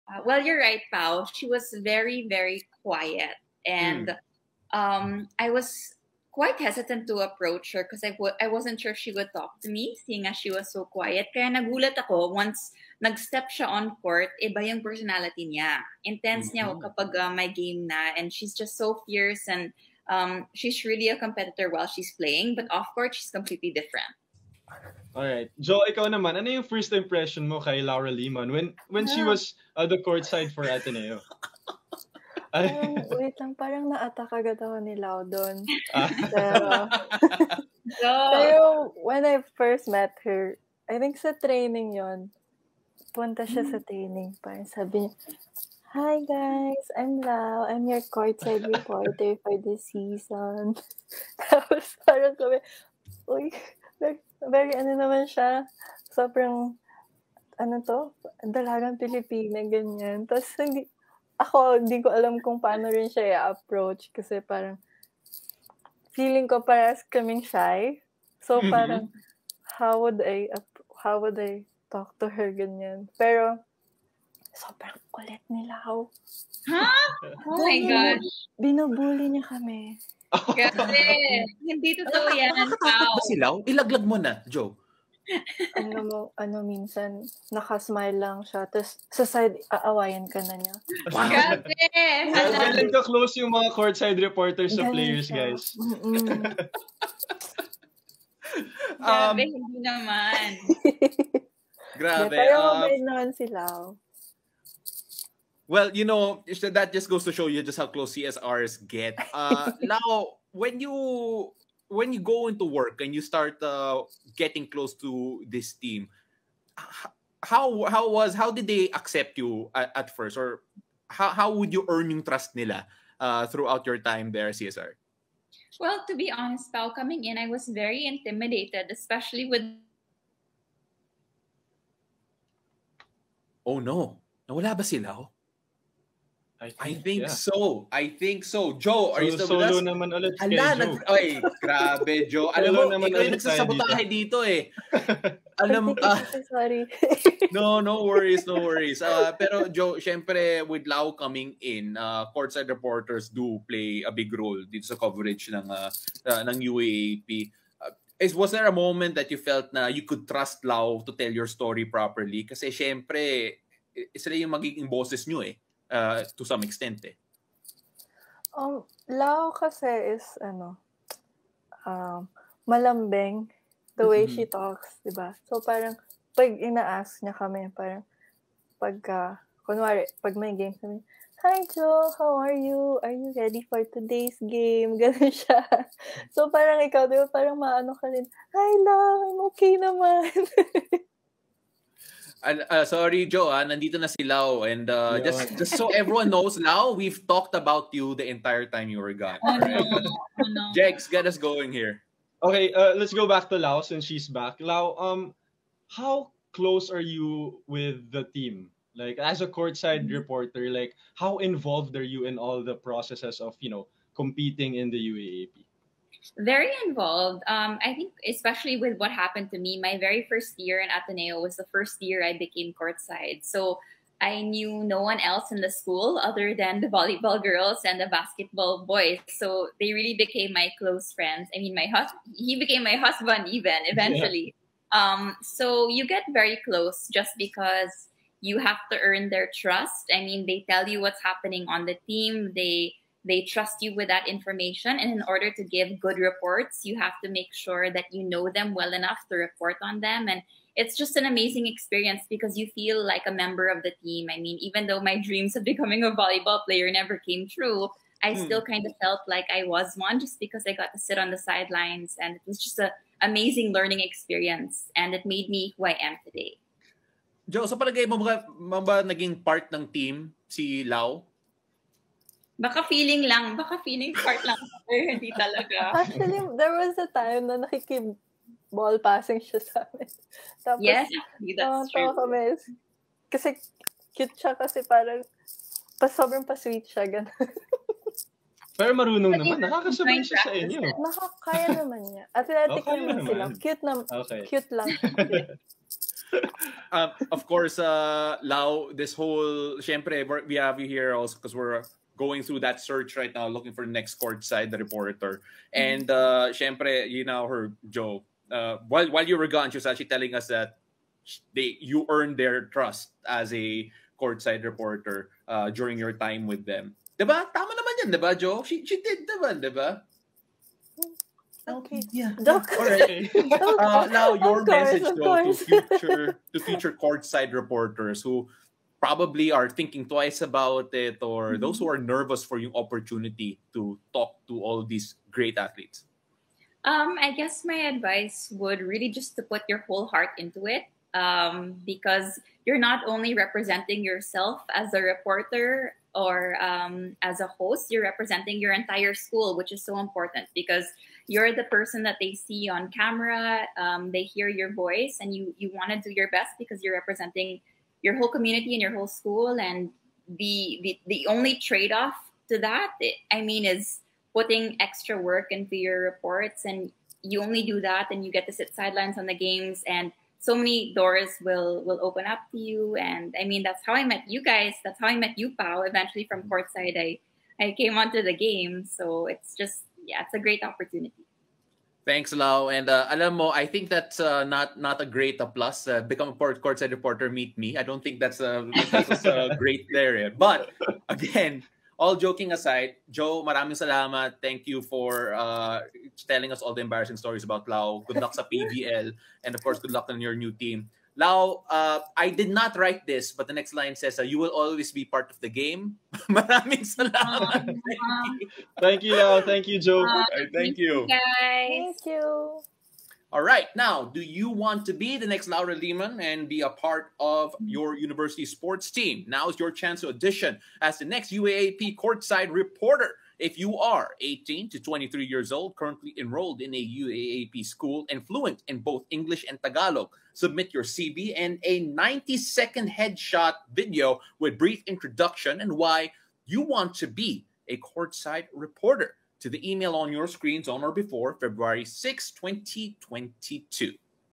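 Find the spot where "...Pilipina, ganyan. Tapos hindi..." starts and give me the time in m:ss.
0:58.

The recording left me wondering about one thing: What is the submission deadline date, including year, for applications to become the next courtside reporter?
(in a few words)
February 6, 2022.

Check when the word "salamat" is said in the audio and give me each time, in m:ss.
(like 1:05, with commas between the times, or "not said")
6:33, 6:46.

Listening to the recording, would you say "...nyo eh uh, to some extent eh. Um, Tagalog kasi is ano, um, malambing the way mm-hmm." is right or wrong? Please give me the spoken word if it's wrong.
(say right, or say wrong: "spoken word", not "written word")
wrong: "Lao", not "Tagalog".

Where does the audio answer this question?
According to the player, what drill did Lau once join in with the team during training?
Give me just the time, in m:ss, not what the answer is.
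4:38.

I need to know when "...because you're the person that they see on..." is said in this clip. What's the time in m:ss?
5:50.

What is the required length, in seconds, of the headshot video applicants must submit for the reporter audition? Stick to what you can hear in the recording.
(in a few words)
90.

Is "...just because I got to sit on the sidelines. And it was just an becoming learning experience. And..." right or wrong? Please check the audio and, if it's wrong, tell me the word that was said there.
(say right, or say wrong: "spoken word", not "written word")
wrong: "amazing", not "becoming".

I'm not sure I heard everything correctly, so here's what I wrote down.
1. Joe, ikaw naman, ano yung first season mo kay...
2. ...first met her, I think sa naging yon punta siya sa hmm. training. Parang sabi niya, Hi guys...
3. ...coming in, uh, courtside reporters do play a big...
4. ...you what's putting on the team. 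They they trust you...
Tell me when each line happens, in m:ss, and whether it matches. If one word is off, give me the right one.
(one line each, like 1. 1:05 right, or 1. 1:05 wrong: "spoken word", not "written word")
1. 0:25 wrong: "impression", not "season"
2. 0:39 wrong: "training", not "naging"
3. 2:31 right
4. 4:00 wrong: "happening", not "putting".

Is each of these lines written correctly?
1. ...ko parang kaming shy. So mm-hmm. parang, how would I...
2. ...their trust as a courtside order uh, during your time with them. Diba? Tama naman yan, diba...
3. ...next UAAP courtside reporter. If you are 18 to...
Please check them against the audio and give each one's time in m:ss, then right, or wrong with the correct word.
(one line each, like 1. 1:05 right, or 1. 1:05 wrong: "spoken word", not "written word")
1. 1:06 right
2. 5:12 wrong: "reporter", not "order"
3. 7:01 right.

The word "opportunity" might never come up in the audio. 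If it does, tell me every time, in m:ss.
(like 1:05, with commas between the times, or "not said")
5:32, 6:20.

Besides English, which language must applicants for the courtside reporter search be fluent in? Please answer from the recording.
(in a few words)
Tagalog.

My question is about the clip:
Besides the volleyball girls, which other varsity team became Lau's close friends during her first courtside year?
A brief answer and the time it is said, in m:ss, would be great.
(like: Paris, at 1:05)
Basketball boys, at 3:48.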